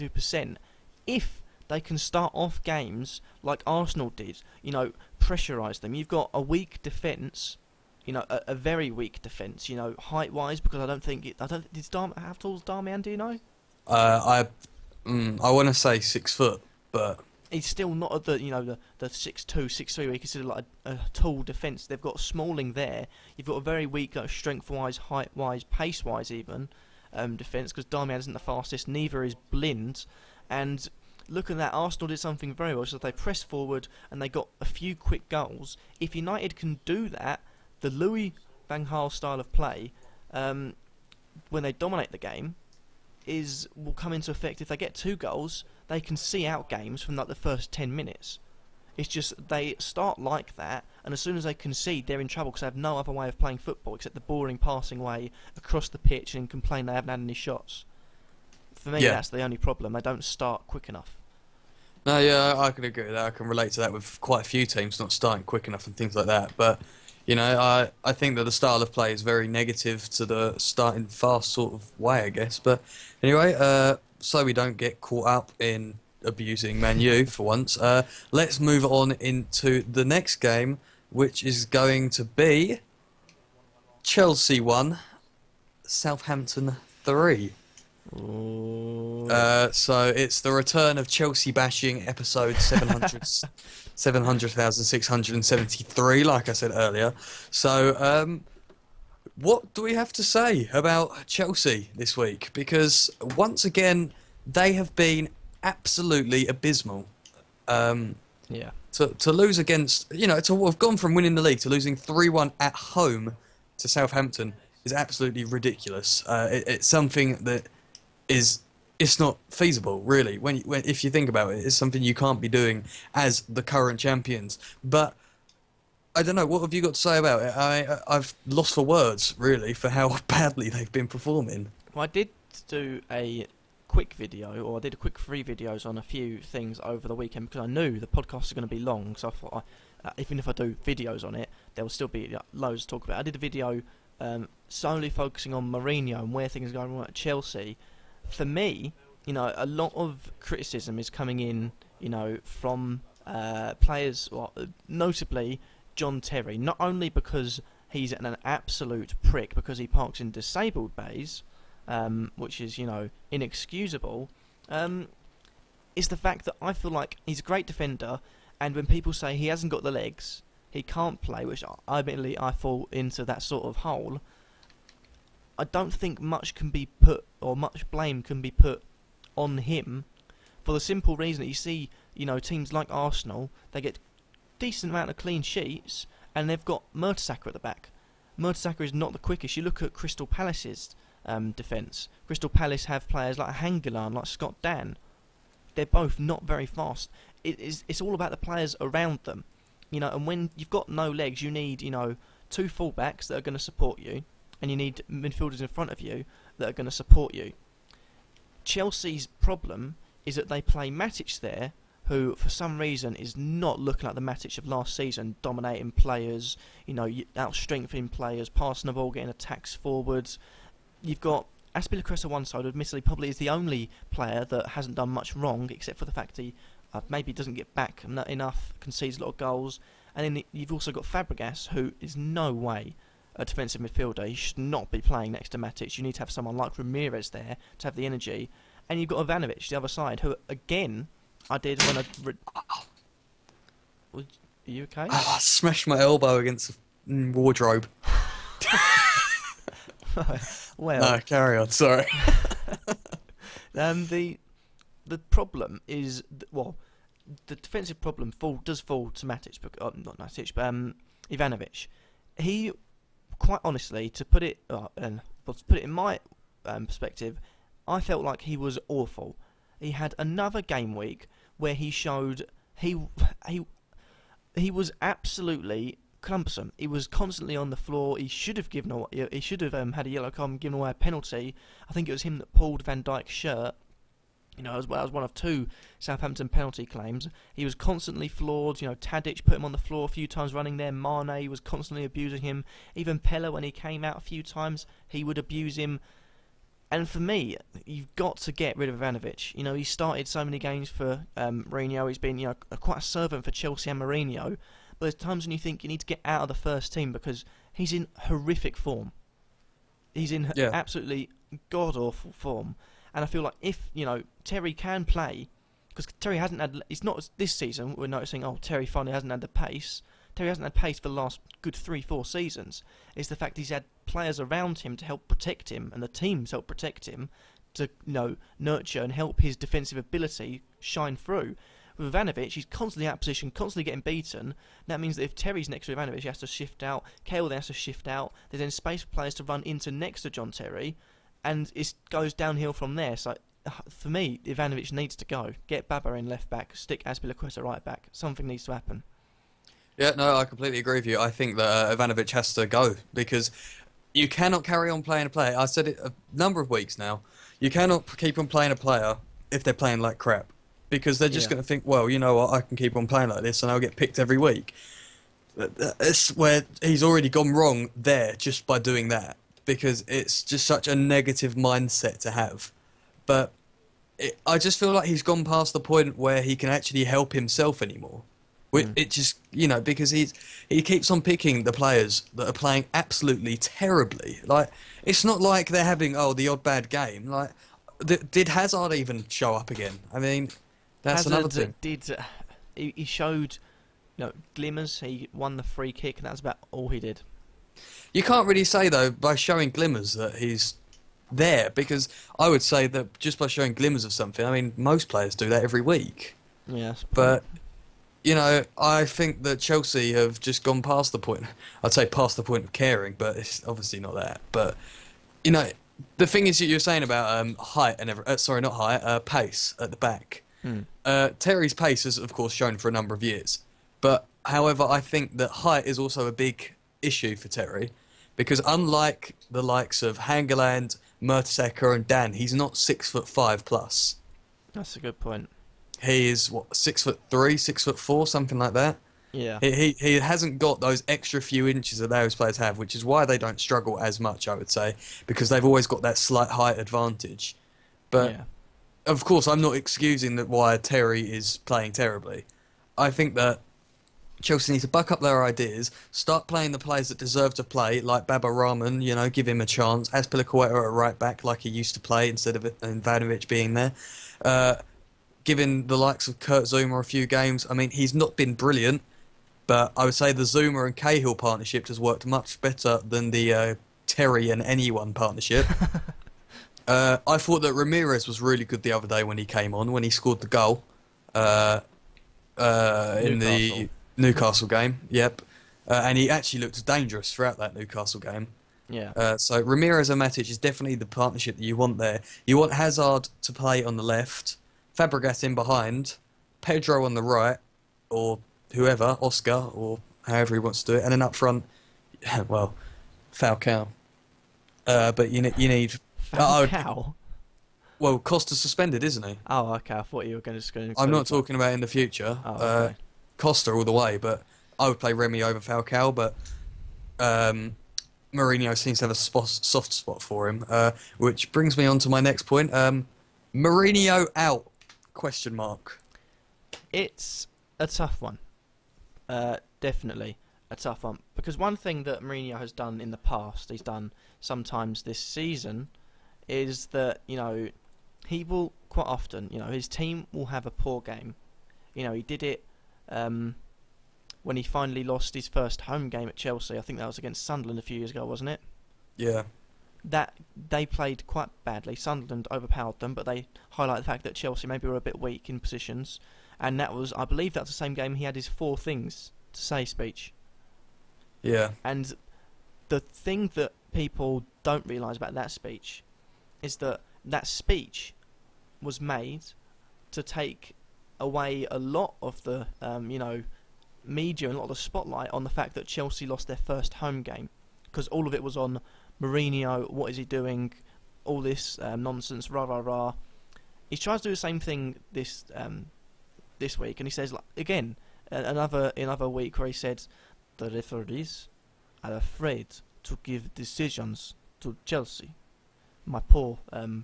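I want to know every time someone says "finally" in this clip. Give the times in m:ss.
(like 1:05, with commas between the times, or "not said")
5:18, 9:04.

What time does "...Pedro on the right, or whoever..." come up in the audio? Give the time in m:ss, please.
8:16.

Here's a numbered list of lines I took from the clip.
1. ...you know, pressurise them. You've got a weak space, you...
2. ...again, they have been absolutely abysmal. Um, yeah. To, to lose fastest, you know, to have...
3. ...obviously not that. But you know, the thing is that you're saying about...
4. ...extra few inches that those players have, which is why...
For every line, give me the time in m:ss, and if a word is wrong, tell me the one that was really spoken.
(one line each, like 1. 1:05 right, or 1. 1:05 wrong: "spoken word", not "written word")
1. 0:04 wrong: "defence", not "space"
2. 1:43 wrong: "against", not "fastest"
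3. 6:53 right
4. 7:21 right.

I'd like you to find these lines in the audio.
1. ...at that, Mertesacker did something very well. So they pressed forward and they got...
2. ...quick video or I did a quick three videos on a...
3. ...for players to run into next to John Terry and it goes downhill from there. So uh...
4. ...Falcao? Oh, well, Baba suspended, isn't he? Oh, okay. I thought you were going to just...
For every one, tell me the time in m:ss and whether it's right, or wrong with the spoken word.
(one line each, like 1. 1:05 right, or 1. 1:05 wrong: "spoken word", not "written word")
1. 0:31 wrong: "Arsenal", not "Mertesacker"
2. 2:13 right
3. 5:39 right
4. 8:26 wrong: "Costa", not "Baba".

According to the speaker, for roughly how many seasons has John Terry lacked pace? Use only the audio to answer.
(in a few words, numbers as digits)
3 or 4 seasons.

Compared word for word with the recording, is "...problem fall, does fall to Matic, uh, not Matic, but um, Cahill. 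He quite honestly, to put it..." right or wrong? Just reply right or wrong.
wrong.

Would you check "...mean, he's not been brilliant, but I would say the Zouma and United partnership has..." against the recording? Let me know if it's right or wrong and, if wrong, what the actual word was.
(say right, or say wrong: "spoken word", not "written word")
wrong: "Cahill", not "United".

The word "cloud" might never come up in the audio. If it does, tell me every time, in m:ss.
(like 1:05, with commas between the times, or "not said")
not said.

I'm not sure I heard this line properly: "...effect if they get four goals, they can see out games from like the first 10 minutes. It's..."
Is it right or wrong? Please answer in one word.
wrong.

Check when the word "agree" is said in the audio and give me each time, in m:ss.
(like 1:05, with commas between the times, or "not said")
1:02, 5:50.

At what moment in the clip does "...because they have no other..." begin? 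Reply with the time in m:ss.
0:52.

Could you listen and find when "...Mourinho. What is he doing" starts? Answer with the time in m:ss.
9:39.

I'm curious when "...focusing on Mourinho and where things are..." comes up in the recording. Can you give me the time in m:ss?
2:25.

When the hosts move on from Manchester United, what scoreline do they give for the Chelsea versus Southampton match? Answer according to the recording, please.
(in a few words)
Chelsea 1, Southampton 3.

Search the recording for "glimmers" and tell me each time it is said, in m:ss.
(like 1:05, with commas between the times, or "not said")
6:34, 6:39, 6:43.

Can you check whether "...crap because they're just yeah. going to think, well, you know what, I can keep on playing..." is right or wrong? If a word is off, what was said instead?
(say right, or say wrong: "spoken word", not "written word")
right.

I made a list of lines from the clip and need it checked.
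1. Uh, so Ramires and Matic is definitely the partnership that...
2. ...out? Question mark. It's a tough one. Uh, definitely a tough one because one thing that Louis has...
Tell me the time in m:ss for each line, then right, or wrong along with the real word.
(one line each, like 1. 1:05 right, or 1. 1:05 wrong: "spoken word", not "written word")
1. 8:09 right
2. 8:44 wrong: "Mourinho", not "Louis".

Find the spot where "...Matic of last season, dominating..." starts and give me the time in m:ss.
3:34.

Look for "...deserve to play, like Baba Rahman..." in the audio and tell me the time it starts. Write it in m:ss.
7:37.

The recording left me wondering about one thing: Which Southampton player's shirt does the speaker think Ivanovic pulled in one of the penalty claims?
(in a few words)
Van Dijk.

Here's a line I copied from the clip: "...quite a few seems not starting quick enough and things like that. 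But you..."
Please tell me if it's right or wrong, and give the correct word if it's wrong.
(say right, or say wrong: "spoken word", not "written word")
wrong: "teams", not "seems".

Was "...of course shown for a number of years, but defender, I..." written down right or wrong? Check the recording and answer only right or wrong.
wrong.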